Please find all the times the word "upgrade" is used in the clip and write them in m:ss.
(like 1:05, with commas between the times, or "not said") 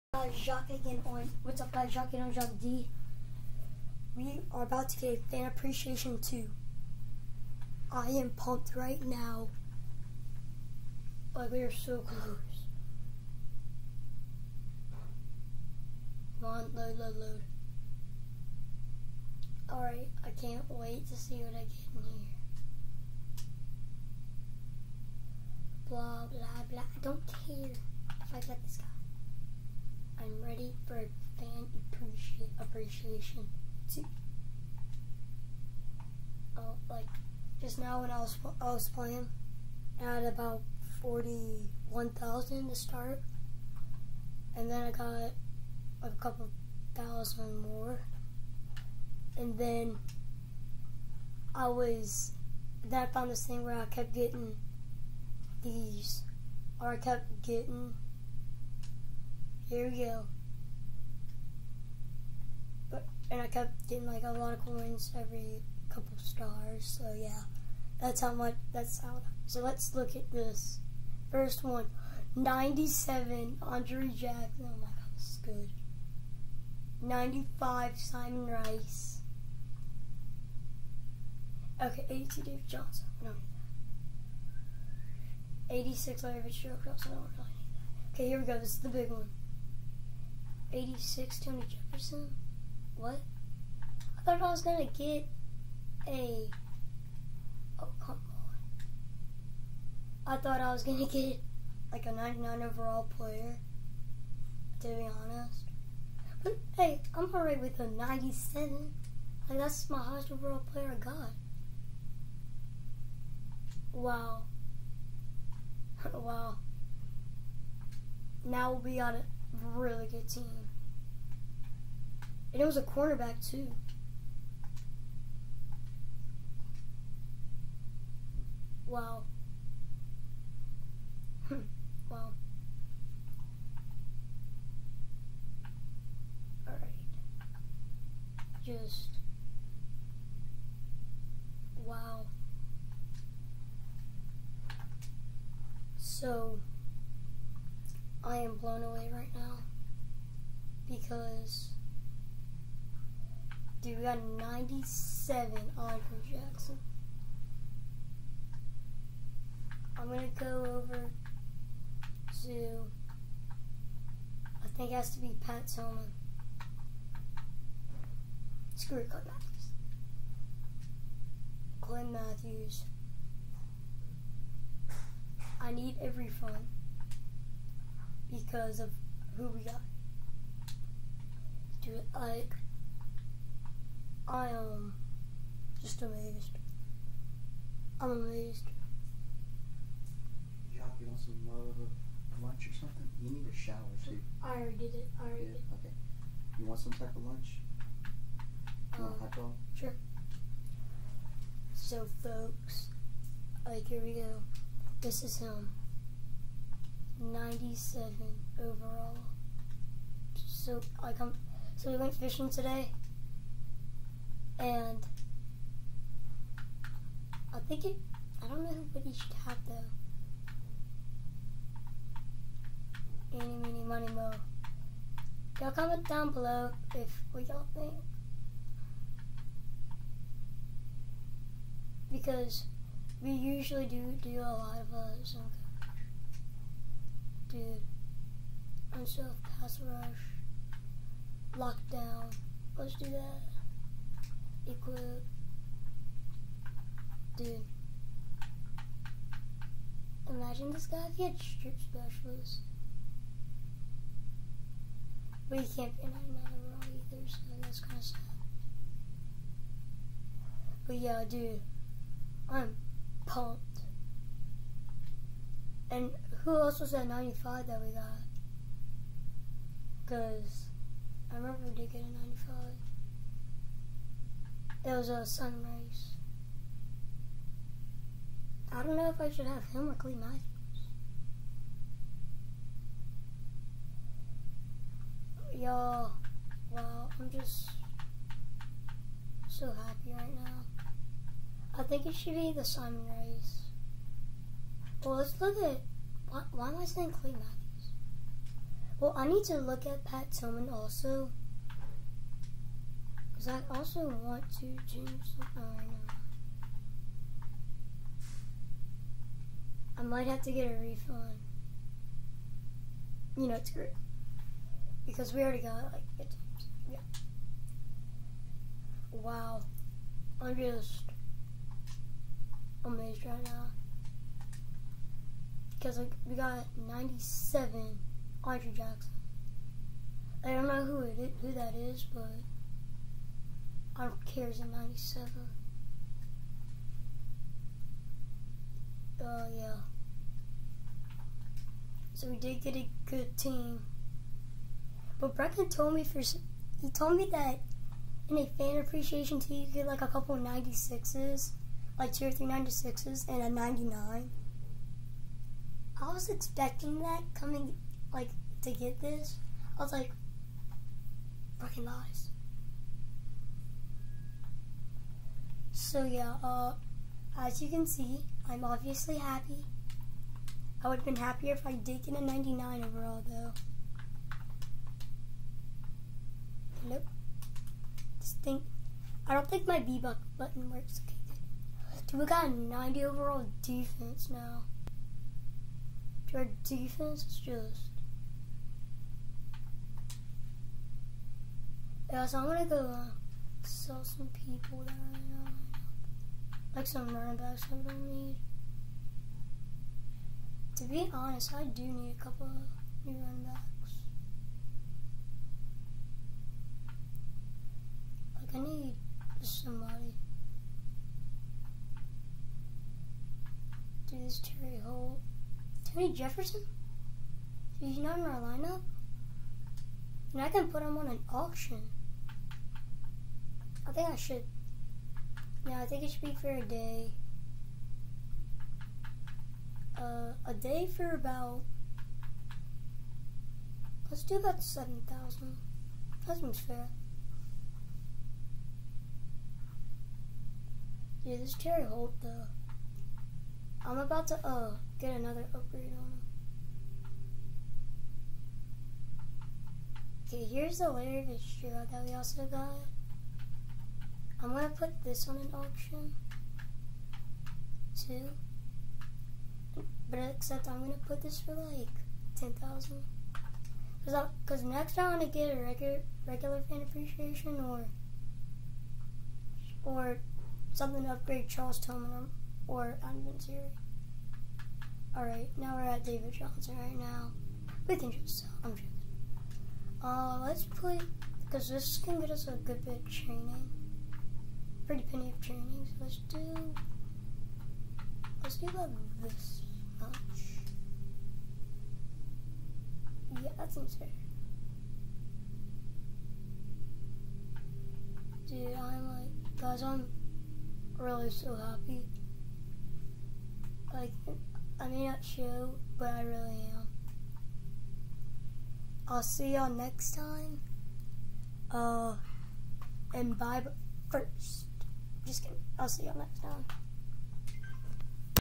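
7:25, 7:51.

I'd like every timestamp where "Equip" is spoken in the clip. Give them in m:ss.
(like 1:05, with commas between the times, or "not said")
4:04.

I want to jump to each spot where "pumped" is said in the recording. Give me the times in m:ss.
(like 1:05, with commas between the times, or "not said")
0:08, 4:23.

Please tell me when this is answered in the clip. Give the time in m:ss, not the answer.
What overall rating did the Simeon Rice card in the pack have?
1:17.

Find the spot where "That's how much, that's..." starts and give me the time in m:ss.
1:08.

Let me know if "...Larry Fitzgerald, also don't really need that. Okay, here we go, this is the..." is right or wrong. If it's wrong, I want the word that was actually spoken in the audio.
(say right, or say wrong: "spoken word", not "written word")
right.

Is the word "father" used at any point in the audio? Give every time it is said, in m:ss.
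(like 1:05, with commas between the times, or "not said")
not said.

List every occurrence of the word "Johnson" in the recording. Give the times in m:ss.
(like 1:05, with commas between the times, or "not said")
1:22, 7:56.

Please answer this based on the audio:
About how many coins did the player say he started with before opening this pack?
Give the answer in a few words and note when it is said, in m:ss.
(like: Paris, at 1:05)
41,000, at 0:41.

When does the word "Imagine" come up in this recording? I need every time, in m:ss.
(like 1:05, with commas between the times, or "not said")
4:10.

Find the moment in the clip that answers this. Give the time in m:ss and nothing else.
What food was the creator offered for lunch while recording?
3:19.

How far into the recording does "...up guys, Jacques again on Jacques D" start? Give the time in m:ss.
0:01.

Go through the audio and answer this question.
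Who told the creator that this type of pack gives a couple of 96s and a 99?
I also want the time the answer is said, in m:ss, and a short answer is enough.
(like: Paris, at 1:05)
Brecken, at 5:45.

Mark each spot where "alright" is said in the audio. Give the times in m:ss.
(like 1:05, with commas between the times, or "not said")
0:19, 1:47, 2:16, 7:55.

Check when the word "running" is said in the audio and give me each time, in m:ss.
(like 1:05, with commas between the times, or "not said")
6:37, 6:43.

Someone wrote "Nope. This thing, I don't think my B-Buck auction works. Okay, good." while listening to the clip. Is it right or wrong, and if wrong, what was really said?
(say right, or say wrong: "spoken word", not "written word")
wrong: "button", not "auction".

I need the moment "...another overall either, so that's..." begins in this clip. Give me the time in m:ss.
4:16.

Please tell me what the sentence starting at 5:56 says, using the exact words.
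I was expecting that coming, like, to get this.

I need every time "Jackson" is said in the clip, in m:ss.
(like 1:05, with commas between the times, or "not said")
1:14, 2:36, 5:28.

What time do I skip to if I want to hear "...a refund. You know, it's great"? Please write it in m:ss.
5:10.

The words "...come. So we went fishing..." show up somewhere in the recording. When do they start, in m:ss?
3:31.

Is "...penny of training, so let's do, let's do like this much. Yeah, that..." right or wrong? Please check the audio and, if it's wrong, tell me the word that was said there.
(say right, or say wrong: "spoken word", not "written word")
right.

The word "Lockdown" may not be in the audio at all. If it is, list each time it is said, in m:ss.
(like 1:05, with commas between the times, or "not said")
4:01.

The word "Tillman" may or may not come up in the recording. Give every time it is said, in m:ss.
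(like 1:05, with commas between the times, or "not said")
2:45, 5:00, 7:51.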